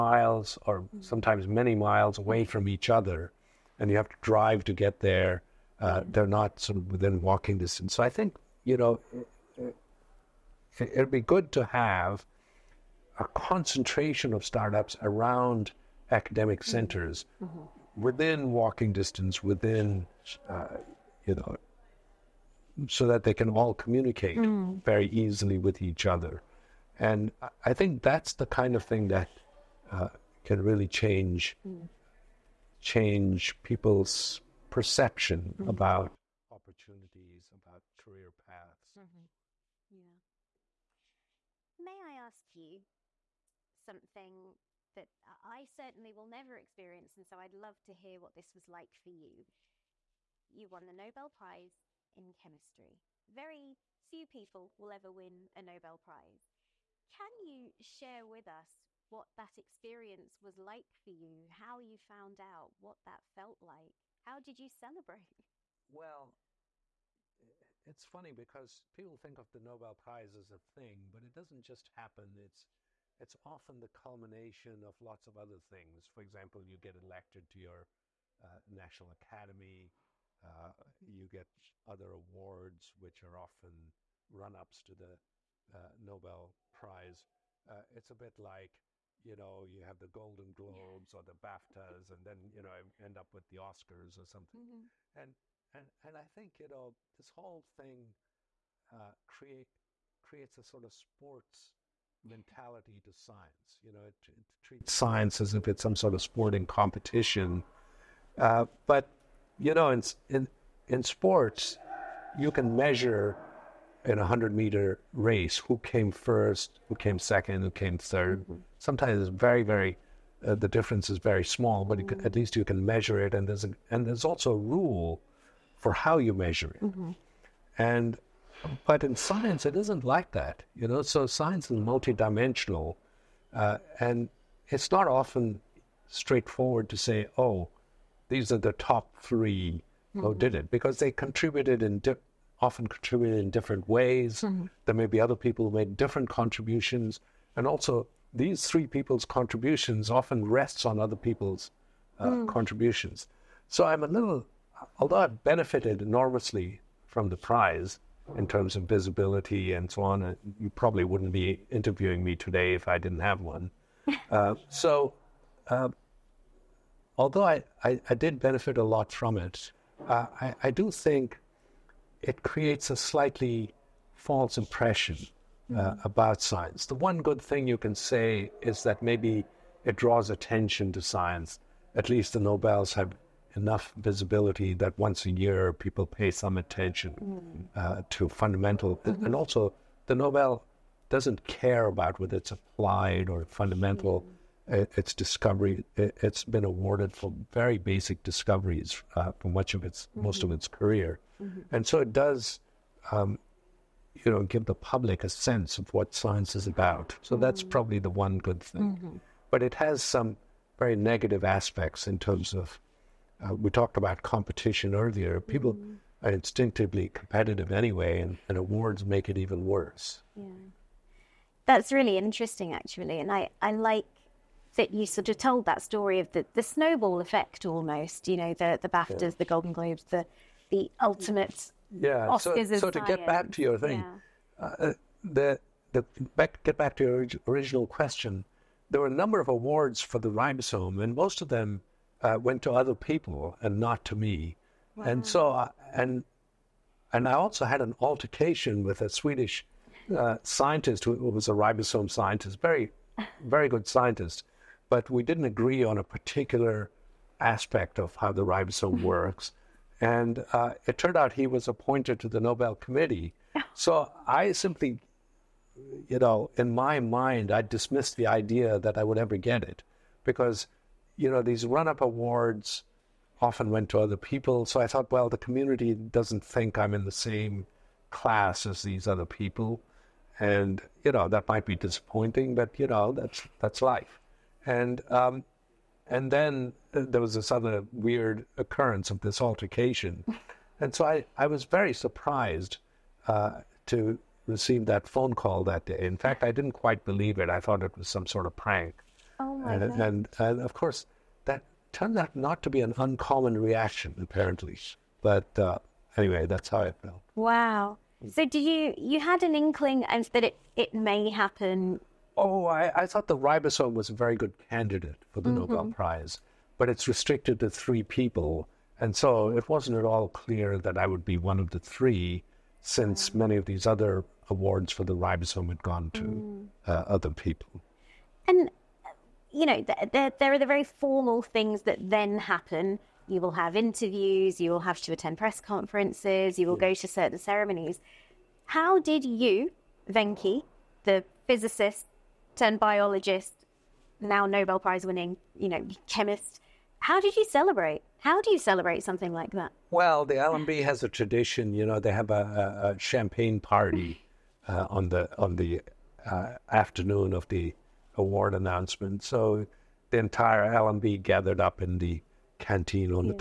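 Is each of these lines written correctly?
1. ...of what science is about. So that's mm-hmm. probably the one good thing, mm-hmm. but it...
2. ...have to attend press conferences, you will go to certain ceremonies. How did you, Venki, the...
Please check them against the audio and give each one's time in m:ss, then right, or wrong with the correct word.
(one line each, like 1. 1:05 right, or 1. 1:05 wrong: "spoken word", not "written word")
1. 3:25 right
2. 5:34 right.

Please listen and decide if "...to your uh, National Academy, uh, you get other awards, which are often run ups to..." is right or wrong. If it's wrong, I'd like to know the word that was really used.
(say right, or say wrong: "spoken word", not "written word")
right.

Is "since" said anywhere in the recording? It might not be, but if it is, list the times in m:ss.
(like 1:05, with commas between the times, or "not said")
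5:22.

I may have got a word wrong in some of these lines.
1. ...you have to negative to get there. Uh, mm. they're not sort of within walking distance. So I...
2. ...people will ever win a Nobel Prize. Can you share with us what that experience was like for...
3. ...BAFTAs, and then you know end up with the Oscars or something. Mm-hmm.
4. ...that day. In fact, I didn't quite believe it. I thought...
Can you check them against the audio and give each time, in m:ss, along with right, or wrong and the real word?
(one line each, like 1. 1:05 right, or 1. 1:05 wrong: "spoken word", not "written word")
1. 0:03 wrong: "drive", not "negative"
2. 0:54 right
3. 1:31 right
4. 4:55 right.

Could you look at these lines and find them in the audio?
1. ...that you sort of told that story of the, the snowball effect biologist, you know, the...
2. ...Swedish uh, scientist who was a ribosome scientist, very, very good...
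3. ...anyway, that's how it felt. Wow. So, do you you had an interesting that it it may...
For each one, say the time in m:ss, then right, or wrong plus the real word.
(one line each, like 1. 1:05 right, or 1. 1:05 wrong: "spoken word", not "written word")
1. 3:44 wrong: "almost", not "biologist"
2. 4:09 right
3. 5:06 wrong: "inkling", not "interesting".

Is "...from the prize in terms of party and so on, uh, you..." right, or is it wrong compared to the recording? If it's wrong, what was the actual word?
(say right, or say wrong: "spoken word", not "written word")
wrong: "visibility", not "party".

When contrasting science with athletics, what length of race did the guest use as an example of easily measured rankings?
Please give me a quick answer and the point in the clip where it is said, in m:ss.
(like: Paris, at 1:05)
100 meter, at 1:54.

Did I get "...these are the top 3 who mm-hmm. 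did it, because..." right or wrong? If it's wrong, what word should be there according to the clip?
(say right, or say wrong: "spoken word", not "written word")
right.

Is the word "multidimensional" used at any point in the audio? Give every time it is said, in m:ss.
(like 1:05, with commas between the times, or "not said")
2:11.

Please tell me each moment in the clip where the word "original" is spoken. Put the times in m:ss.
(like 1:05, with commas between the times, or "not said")
3:57.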